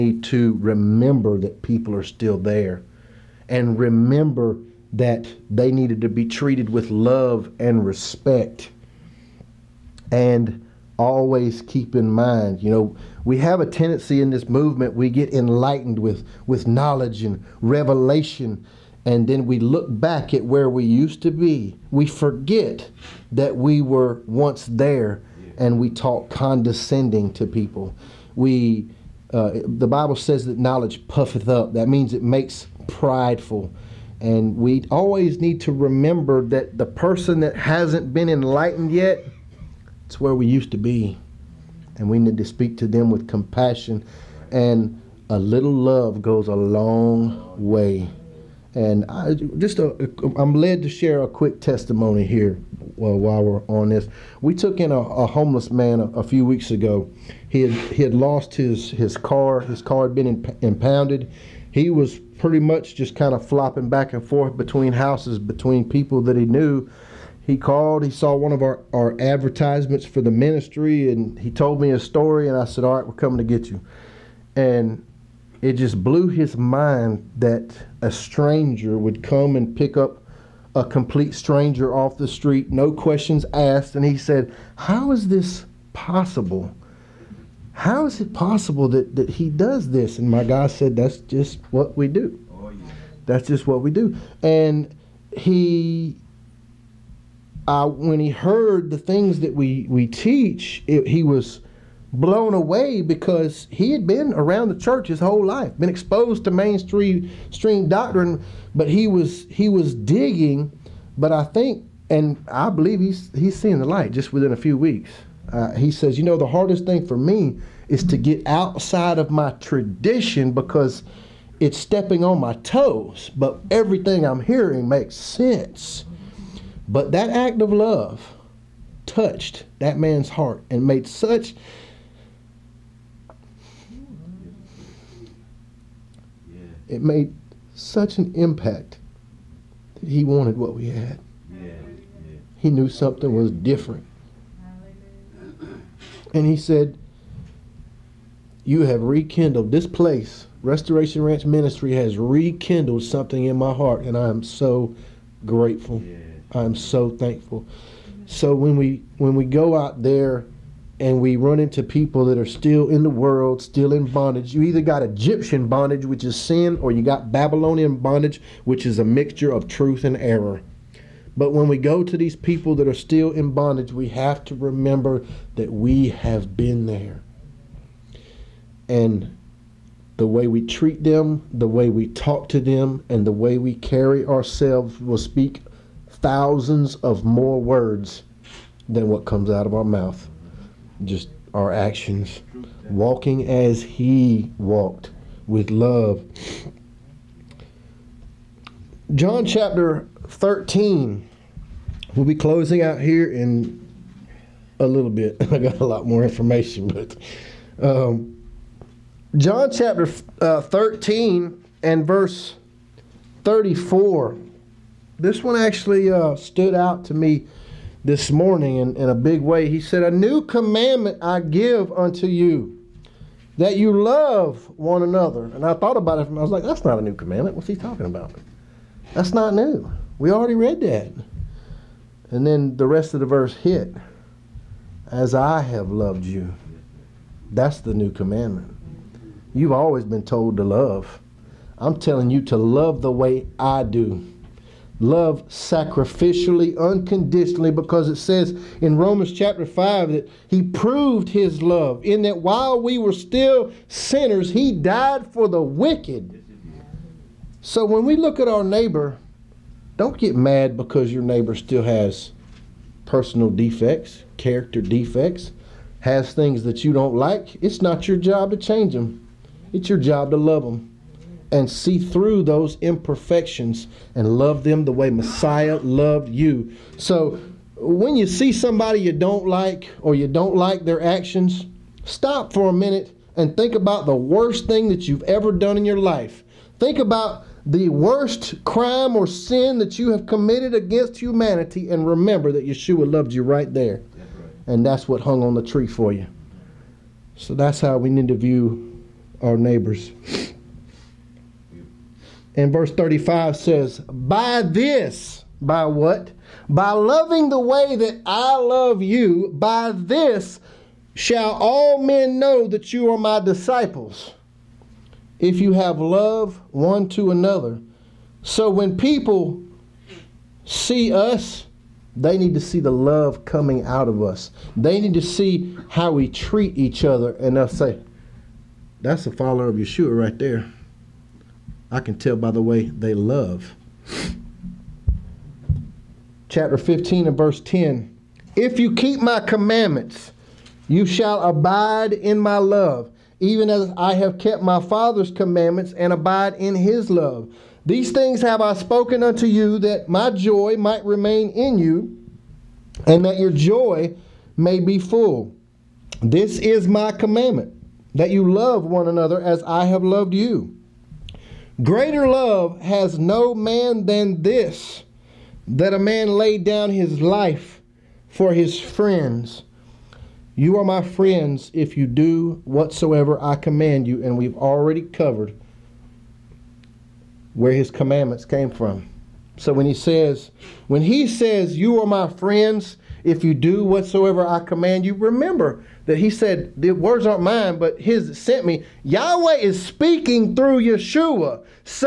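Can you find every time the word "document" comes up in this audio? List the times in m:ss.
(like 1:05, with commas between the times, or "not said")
not said.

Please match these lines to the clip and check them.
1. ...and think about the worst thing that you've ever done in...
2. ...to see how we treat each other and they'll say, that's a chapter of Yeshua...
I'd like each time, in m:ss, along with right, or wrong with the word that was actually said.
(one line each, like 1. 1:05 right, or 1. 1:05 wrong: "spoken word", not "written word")
1. 4:43 right
2. 5:25 wrong: "follower", not "chapter".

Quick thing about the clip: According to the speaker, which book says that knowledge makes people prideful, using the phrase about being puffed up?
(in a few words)
The Bible.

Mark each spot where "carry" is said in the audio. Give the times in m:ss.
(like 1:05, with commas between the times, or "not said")
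3:03.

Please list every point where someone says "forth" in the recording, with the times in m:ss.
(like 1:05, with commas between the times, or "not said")
1:04.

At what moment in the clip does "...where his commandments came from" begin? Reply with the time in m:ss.
6:17.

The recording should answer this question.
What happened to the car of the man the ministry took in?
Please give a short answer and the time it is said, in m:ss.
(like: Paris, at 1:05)
Impounded, at 1:00.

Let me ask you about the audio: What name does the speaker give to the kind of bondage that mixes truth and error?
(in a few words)
Babylonian bondage.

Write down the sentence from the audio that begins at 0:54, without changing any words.
We took in a, a homeless man a, a, few weeks ago.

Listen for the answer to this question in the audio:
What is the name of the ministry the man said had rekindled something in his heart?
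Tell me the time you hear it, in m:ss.
2:30.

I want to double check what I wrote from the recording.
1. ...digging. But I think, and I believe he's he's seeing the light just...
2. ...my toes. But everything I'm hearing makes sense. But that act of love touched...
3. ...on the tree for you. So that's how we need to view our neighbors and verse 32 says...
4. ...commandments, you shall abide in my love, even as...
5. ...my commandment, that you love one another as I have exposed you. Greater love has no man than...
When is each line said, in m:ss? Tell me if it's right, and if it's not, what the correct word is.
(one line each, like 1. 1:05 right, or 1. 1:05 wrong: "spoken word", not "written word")
1. 1:49 right
2. 2:02 right
3. 4:55 wrong: "35", not "32"
4. 5:39 right
5. 5:56 wrong: "loved", not "exposed".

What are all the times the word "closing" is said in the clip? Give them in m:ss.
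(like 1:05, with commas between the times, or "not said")
3:22.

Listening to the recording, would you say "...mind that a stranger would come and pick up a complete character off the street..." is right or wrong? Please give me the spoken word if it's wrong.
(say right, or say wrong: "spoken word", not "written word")
wrong: "stranger", not "character".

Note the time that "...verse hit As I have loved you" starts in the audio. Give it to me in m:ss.
3:53.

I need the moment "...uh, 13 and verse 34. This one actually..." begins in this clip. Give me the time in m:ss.
3:30.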